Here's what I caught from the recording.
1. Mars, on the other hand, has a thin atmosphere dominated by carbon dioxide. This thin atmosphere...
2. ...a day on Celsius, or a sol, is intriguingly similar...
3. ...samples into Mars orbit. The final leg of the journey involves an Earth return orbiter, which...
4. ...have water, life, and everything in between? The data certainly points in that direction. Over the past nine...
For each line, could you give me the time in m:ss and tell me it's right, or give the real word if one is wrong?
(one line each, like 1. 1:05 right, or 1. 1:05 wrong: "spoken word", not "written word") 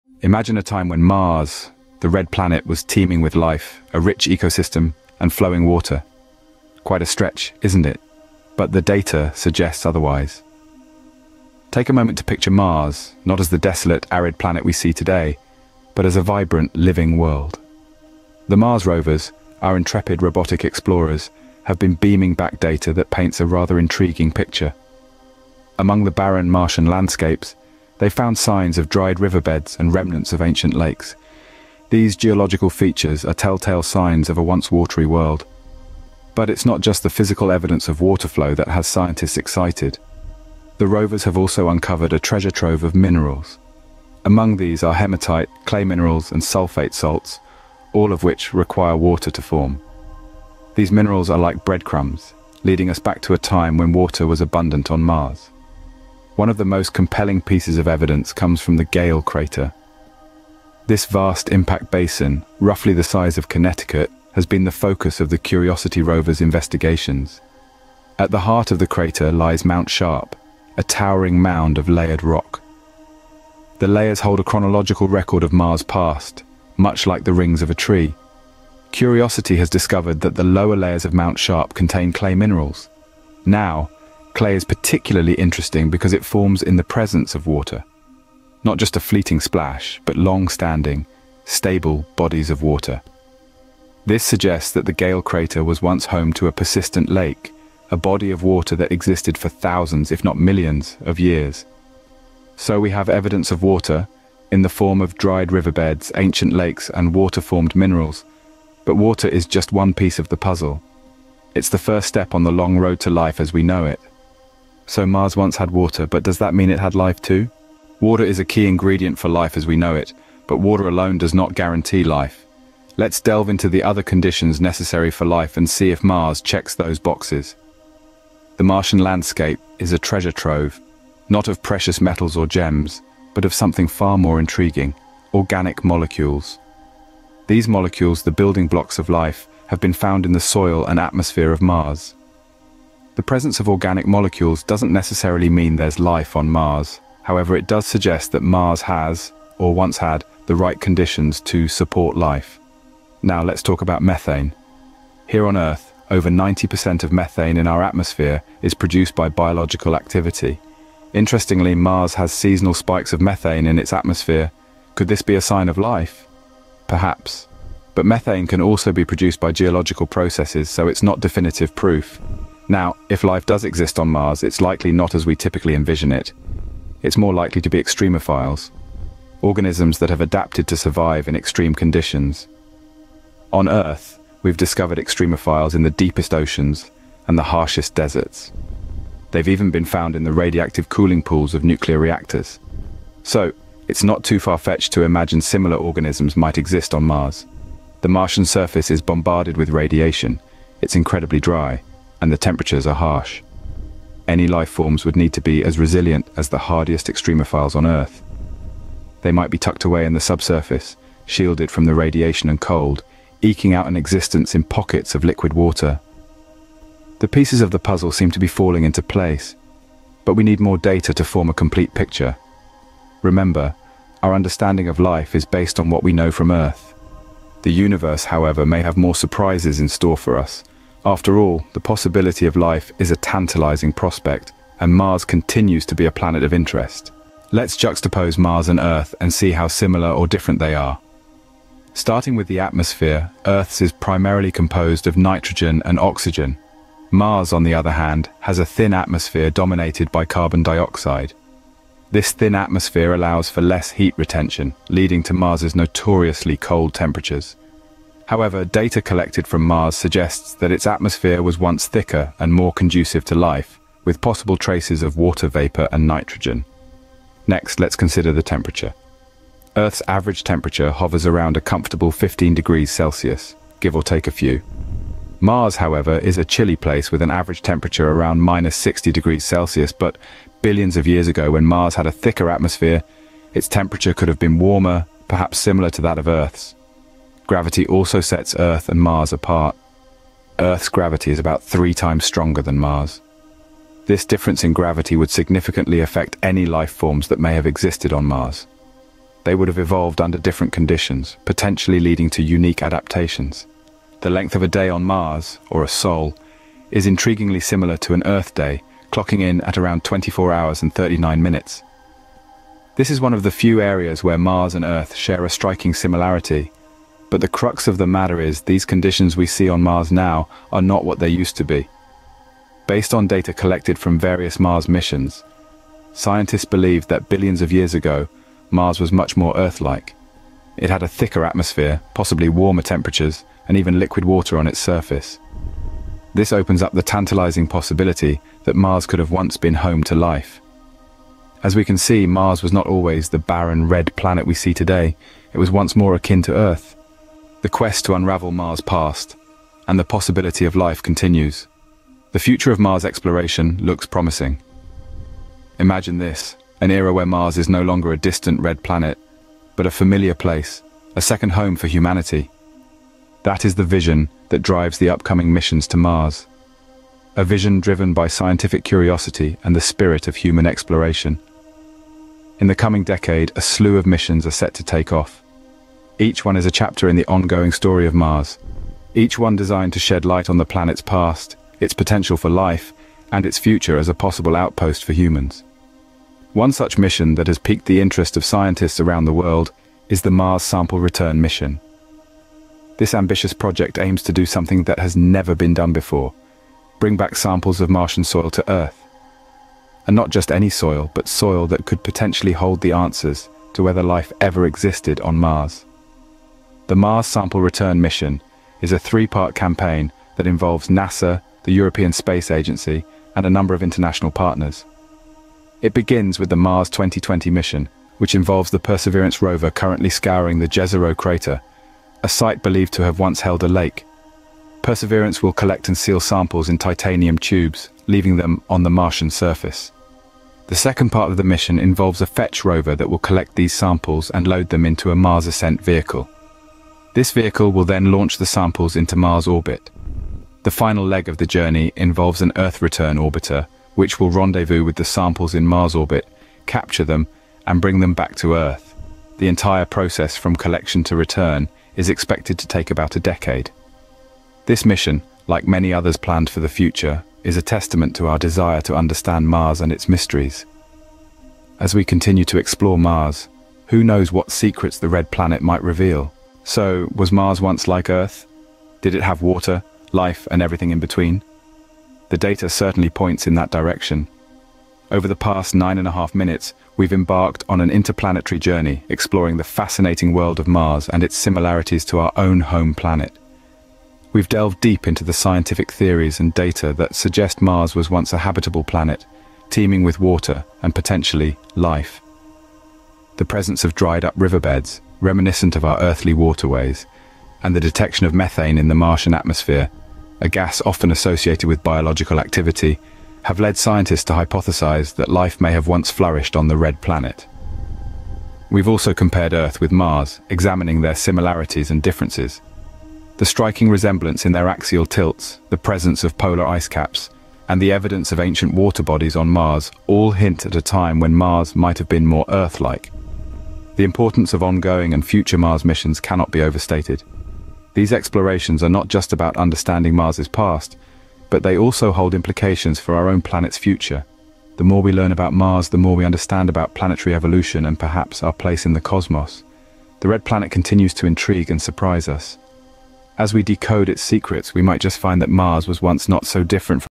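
1. 4:07 right
2. 5:04 wrong: "Mars", not "Celsius"
3. 7:18 right
4. 7:49 right.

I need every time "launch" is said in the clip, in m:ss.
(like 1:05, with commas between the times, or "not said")
7:18.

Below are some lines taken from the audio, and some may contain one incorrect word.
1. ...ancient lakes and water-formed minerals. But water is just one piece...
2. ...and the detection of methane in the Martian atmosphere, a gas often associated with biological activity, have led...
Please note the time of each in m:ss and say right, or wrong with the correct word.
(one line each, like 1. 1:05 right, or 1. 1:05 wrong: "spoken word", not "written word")
1. 1:46 right
2. 8:17 right.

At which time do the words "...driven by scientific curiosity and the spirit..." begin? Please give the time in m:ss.
6:07.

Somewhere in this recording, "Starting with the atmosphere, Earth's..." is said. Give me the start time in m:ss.
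4:01.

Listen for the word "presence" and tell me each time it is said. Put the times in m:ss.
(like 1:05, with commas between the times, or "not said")
1:26, 2:23, 8:13, 8:35.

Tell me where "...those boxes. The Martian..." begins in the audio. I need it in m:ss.
2:06.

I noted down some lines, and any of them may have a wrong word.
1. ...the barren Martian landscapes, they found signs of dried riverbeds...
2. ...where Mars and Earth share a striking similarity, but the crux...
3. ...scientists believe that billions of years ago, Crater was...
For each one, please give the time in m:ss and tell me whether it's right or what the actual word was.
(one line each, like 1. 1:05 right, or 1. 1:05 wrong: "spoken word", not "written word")
1. 0:26 right
2. 5:14 right
3. 5:26 wrong: "Mars", not "Crater".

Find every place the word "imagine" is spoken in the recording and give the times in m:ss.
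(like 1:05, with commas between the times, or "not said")
0:00, 3:15, 5:55.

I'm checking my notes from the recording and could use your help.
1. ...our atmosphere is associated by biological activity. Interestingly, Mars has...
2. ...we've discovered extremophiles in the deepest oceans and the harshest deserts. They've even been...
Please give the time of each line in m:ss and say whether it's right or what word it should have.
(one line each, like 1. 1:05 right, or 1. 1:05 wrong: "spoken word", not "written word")
1. 2:37 wrong: "produced", not "associated"
2. 3:04 right.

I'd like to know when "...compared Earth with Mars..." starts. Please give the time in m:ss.
8:29.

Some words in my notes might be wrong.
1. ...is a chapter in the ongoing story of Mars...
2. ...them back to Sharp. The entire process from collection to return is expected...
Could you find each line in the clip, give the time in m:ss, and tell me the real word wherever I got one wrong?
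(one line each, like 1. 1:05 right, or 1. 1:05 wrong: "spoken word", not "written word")
1. 6:16 right
2. 7:27 wrong: "Earth", not "Sharp".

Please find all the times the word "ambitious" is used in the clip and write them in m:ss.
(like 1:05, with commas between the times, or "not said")
6:33.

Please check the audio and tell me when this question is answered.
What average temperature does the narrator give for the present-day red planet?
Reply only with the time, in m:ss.
4:38.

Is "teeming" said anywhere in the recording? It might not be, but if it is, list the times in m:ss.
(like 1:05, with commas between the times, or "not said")
0:02, 8:09.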